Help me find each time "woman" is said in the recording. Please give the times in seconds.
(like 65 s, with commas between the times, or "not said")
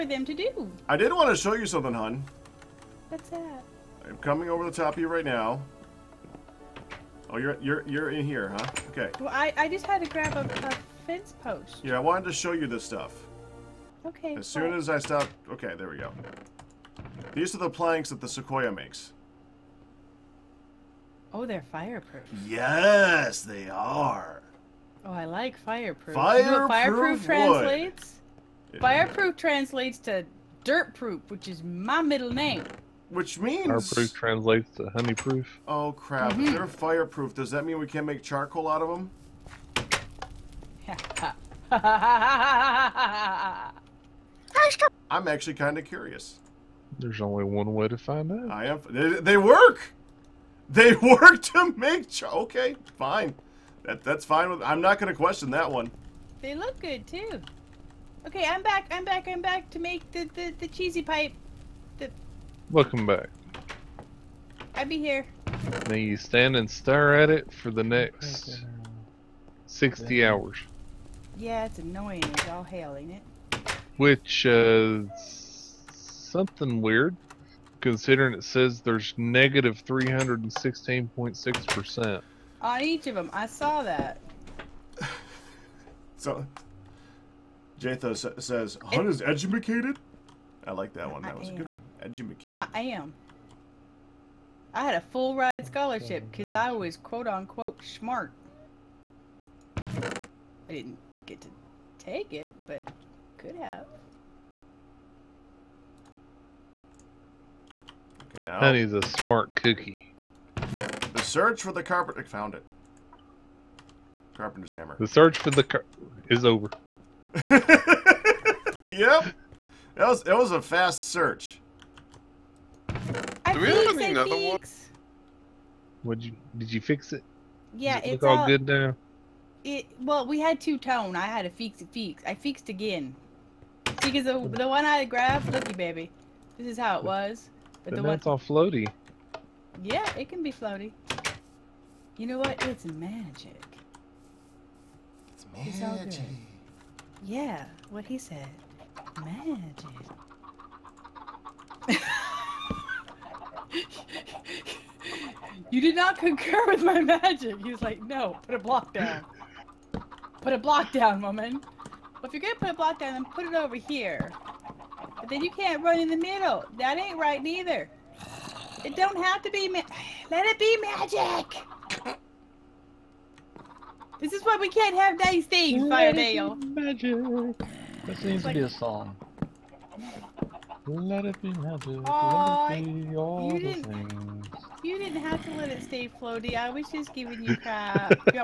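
161 s.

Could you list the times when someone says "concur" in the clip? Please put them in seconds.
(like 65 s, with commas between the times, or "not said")
156 s.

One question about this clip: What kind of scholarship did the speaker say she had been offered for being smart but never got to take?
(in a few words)
Full ride.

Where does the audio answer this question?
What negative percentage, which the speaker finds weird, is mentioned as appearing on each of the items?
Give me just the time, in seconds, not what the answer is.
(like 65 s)
79 s.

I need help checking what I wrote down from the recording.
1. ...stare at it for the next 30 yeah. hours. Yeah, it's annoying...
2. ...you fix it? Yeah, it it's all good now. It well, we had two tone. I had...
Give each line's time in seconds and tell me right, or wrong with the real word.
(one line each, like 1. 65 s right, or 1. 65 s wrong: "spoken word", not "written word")
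1. 66 s wrong: "60", not "30"
2. 126 s right.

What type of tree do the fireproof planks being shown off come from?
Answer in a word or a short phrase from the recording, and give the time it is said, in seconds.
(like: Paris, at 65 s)
Sequoia, at 18 s.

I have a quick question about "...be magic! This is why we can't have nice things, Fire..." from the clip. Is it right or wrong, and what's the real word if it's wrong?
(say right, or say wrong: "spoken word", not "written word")
right.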